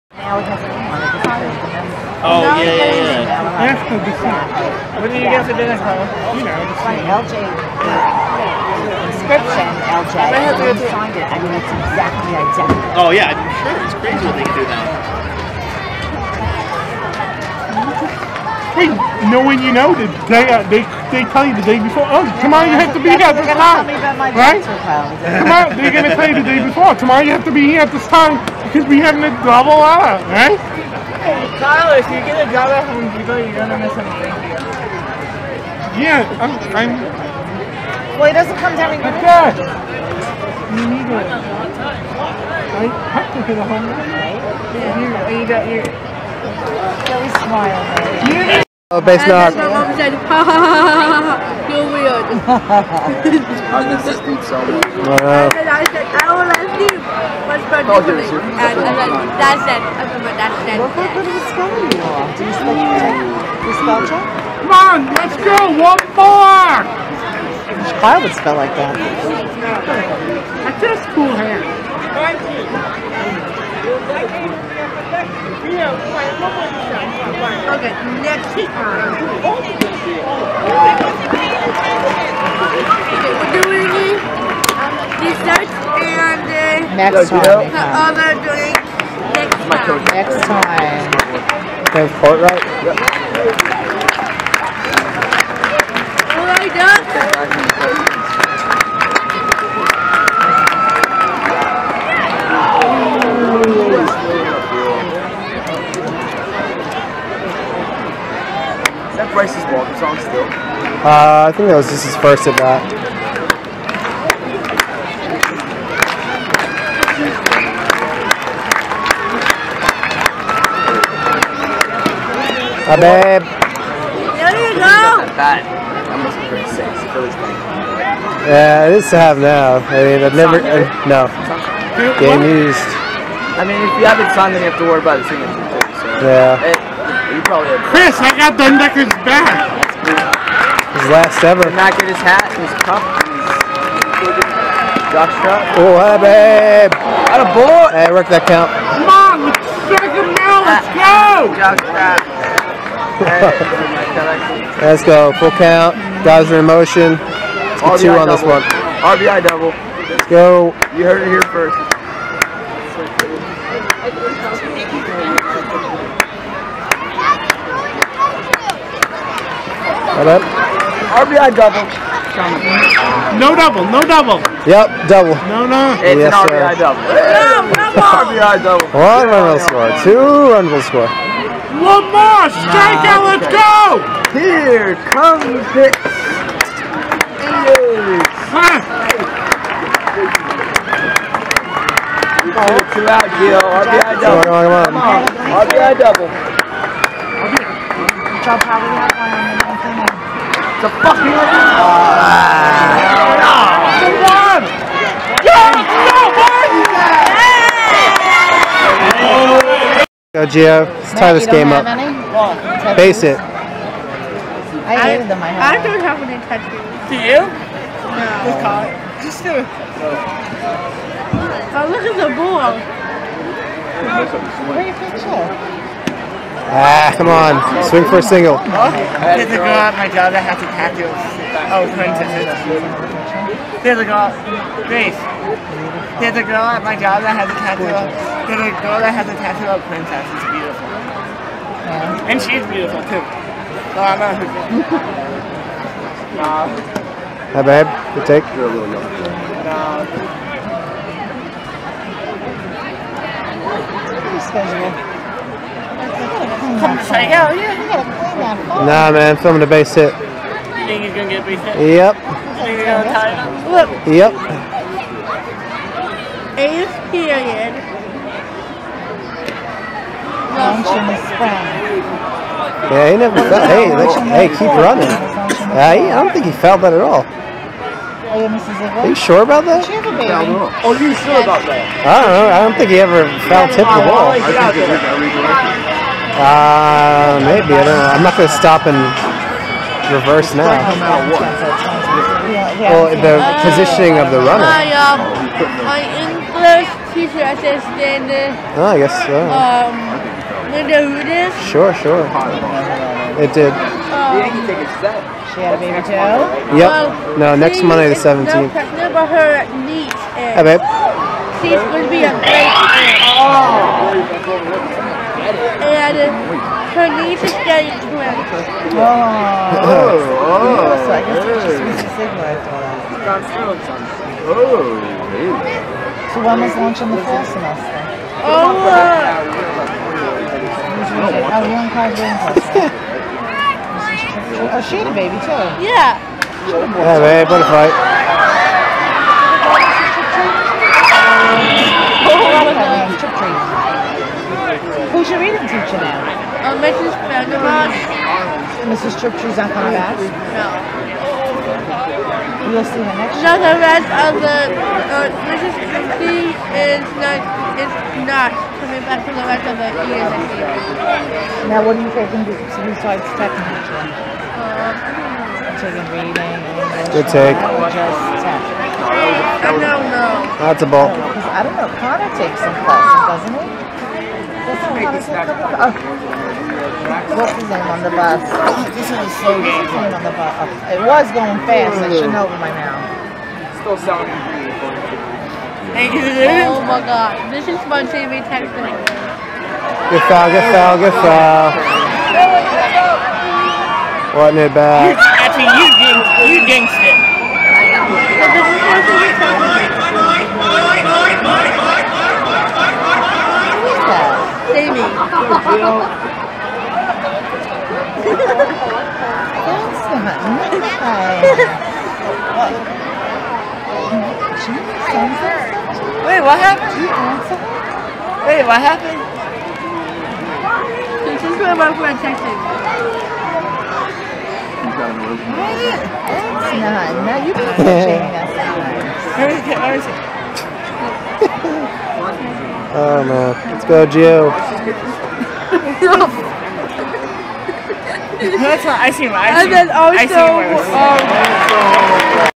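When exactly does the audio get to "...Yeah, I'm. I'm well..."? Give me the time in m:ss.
0:35.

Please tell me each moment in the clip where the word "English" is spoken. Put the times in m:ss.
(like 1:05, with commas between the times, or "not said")
4:56, 6:06.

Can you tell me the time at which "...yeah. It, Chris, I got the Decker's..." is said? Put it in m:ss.
2:16.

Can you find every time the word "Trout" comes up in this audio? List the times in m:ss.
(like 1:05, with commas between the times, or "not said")
2:25, 2:31.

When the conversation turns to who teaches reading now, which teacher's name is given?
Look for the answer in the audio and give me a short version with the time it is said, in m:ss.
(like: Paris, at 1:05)
Mrs. Vandermark, at 5:46.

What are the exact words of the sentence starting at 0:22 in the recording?
Oh, tomorrow you have to be here at this time, right?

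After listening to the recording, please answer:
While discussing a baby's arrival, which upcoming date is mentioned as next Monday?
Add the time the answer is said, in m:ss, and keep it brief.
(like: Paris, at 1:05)
the 17th, at 5:07.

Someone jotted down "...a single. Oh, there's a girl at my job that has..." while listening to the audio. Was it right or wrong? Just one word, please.
right.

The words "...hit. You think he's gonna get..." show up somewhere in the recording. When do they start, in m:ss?
4:19.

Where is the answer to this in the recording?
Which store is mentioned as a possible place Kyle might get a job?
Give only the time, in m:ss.
0:32.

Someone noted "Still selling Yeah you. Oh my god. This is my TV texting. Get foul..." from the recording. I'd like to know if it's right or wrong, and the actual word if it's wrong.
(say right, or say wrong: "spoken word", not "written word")
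wrong: "Thank", not "Yeah".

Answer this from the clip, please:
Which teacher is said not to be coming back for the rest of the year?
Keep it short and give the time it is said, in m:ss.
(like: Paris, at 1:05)
Mrs. Christie, at 5:55.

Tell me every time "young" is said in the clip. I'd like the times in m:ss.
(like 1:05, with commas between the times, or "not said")
4:08, 5:31.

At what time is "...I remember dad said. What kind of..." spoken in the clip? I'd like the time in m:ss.
0:59.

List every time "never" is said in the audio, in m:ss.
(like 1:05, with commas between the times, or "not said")
2:10, 4:33.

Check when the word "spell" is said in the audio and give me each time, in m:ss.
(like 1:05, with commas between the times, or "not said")
1:03, 1:08.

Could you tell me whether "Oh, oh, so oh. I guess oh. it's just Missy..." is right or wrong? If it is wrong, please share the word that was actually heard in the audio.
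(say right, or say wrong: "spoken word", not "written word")
right.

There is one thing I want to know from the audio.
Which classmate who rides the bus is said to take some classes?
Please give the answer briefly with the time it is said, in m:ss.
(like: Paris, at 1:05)
Connor, at 6:12.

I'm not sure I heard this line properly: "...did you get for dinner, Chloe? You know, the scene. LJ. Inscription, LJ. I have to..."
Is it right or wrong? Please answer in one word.
right.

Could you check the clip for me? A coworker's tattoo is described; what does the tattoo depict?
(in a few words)
princess.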